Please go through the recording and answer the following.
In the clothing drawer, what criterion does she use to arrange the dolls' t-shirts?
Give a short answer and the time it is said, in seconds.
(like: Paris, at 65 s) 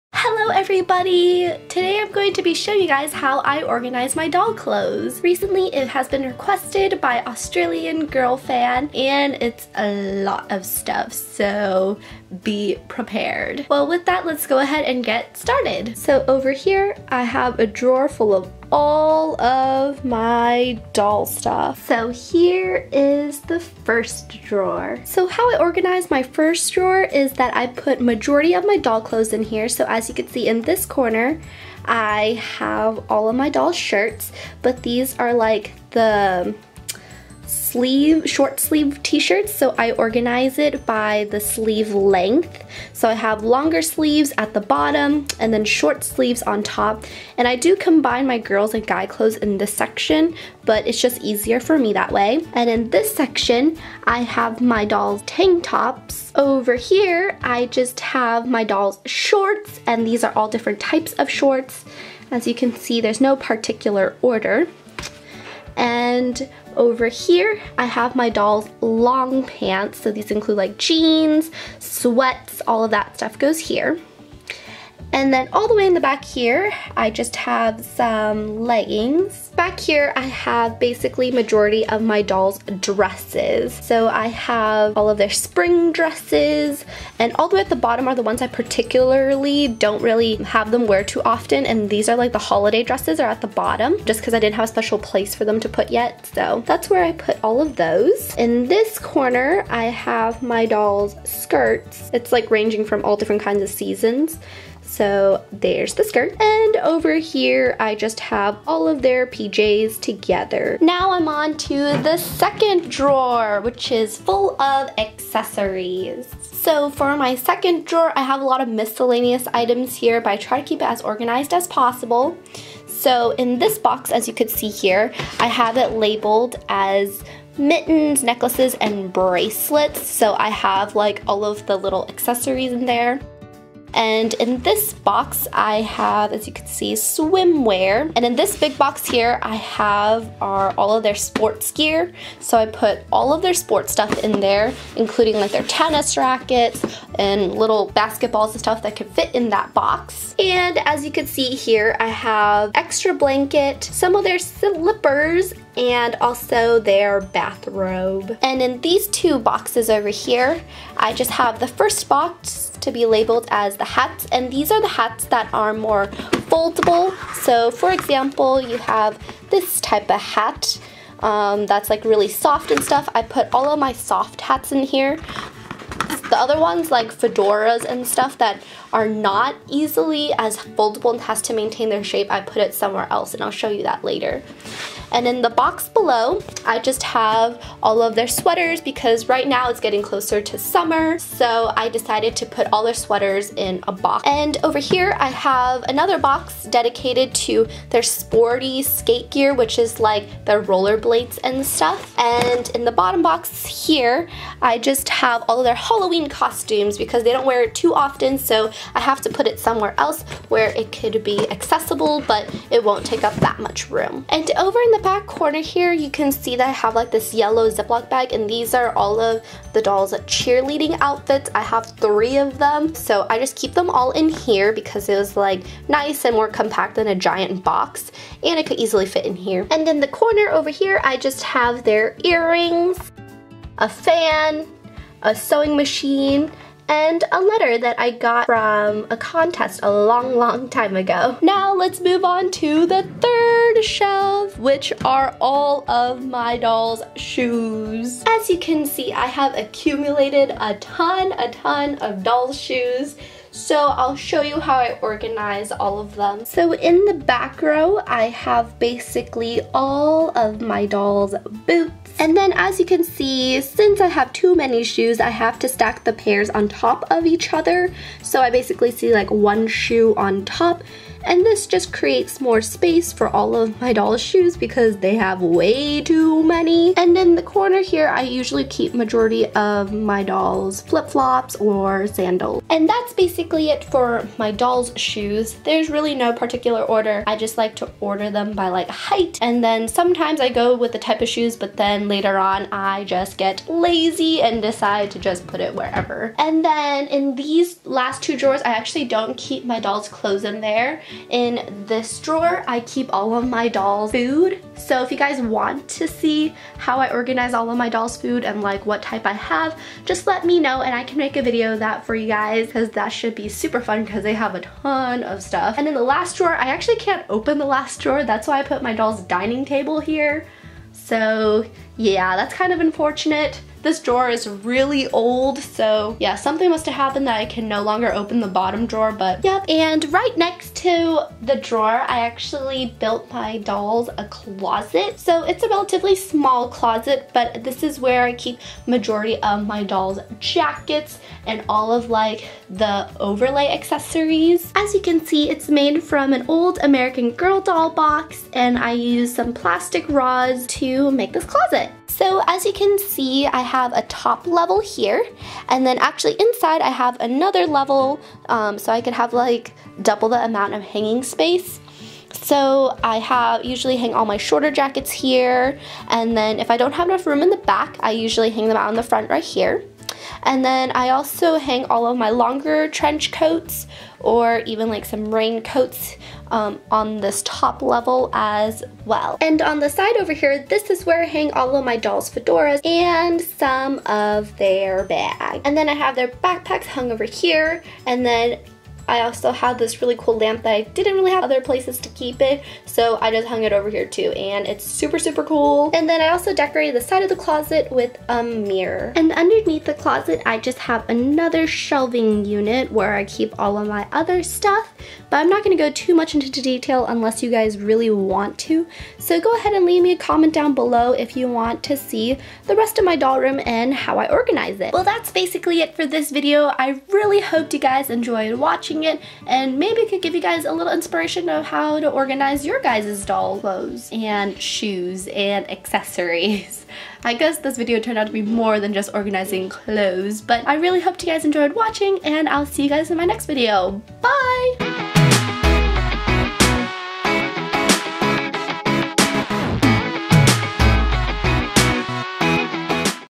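Sleeve length, at 41 s.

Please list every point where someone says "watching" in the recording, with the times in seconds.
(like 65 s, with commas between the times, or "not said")
418 s, 431 s.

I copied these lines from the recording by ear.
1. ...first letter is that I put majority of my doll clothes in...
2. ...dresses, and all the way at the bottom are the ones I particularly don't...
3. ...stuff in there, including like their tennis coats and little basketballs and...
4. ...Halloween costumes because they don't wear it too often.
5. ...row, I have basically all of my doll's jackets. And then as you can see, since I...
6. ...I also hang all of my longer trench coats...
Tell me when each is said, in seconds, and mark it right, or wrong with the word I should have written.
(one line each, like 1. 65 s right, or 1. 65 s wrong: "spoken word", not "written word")
1. 26 s wrong: "drawer", not "letter"
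2. 85 s right
3. 143 s wrong: "rackets", not "coats"
4. 205 s right
5. 257 s wrong: "boots", not "jackets"
6. 370 s right.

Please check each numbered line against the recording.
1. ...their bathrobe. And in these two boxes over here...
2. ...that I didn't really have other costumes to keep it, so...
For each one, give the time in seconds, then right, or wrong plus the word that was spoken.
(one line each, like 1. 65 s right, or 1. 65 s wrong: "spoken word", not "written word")
1. 156 s right
2. 390 s wrong: "places", not "costumes".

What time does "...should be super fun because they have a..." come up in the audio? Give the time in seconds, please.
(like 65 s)
313 s.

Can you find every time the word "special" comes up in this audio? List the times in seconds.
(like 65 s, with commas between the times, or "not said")
94 s.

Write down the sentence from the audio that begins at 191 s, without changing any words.
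So I decided to put all their sweaters in a box.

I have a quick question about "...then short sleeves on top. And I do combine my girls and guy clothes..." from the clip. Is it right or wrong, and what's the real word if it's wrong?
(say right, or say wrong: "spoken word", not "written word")
right.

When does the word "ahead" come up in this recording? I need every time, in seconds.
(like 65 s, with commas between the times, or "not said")
14 s, 409 s.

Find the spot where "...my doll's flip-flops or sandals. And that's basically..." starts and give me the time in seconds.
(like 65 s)
279 s.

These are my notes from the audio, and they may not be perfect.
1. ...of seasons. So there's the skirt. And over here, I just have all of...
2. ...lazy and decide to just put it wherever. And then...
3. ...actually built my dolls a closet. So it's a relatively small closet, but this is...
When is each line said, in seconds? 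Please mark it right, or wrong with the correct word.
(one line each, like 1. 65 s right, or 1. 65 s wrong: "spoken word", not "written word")
1. 103 s right
2. 293 s right
3. 332 s right.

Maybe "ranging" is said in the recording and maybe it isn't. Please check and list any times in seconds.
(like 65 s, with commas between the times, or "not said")
102 s.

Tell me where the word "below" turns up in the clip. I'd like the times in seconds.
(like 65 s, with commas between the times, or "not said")
185 s, 410 s.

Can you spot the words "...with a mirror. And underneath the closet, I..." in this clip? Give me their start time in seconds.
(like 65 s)
397 s.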